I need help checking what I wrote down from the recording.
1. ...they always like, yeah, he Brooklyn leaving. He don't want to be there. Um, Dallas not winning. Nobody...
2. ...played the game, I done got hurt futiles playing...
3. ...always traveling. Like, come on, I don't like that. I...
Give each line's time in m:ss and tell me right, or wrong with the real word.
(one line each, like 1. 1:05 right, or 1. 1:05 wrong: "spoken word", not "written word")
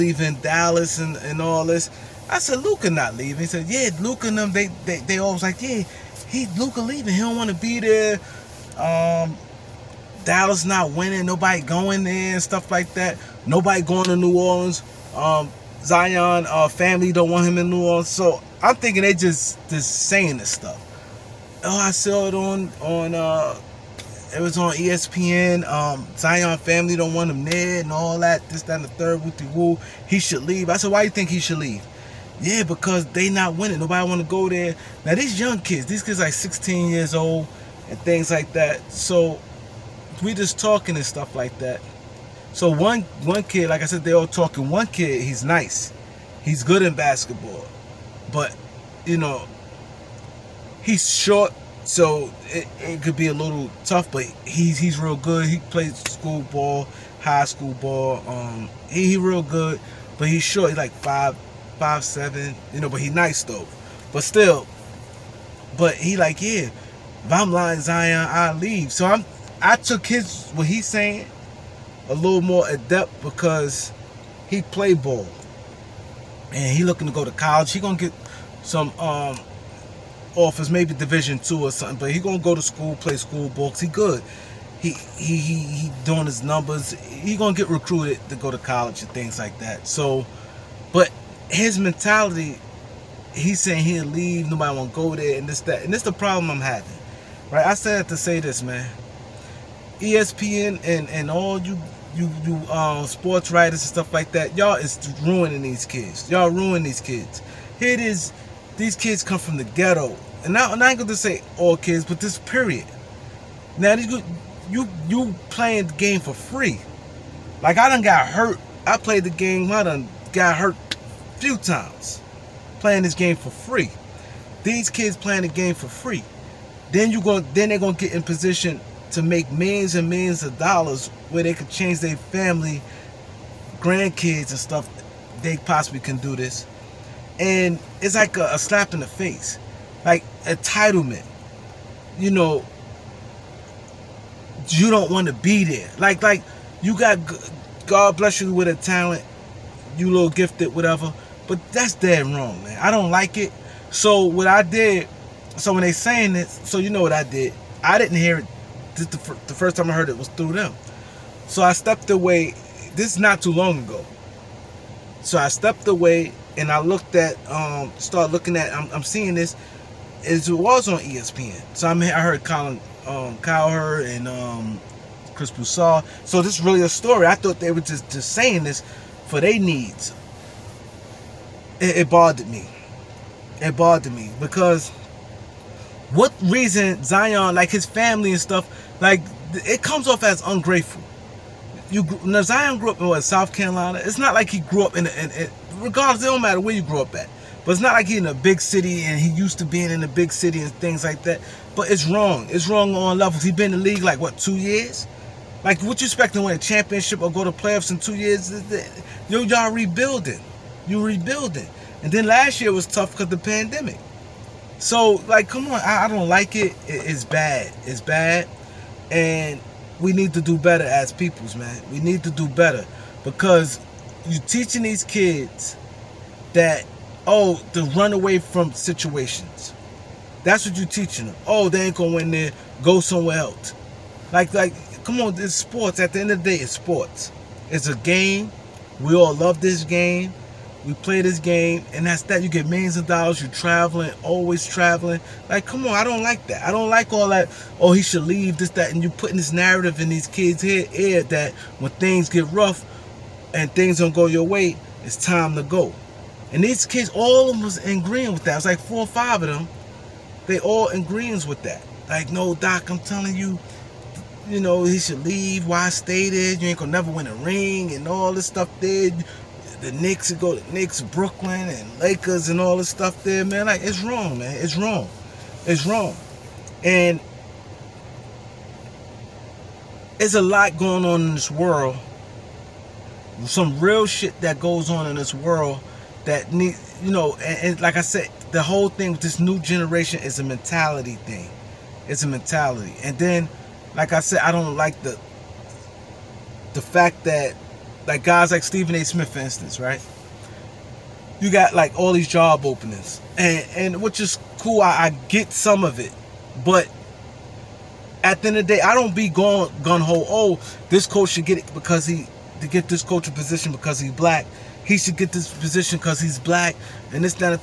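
1. 0:04 wrong: "Luka", not "Brooklyn"
2. 1:58 right
3. 4:04 right.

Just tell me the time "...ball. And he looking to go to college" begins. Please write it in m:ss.
1:14.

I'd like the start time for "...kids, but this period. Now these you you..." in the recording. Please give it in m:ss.
1:51.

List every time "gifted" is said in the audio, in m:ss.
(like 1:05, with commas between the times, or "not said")
2:30.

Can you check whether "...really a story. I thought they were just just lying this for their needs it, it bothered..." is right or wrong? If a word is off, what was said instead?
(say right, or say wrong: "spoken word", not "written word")
wrong: "saying", not "lying".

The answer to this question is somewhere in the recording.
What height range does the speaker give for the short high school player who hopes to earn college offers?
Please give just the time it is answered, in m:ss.
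1:00.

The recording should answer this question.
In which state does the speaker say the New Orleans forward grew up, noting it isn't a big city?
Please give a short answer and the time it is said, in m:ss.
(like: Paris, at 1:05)
South Carolina, at 3:13.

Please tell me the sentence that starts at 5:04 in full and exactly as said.
I, I get some of it, but at the end of the day, I don't be going gun ho.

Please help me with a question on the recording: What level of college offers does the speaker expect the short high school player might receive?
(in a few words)
Division 2.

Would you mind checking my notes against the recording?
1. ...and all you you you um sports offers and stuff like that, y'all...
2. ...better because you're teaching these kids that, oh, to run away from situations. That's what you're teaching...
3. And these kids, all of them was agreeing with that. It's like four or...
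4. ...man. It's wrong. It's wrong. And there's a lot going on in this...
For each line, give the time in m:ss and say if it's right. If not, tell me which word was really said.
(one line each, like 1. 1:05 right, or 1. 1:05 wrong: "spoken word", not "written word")
1. 1:41 wrong: "writers", not "offers"
2. 3:42 right
3. 4:16 right
4. 4:34 right.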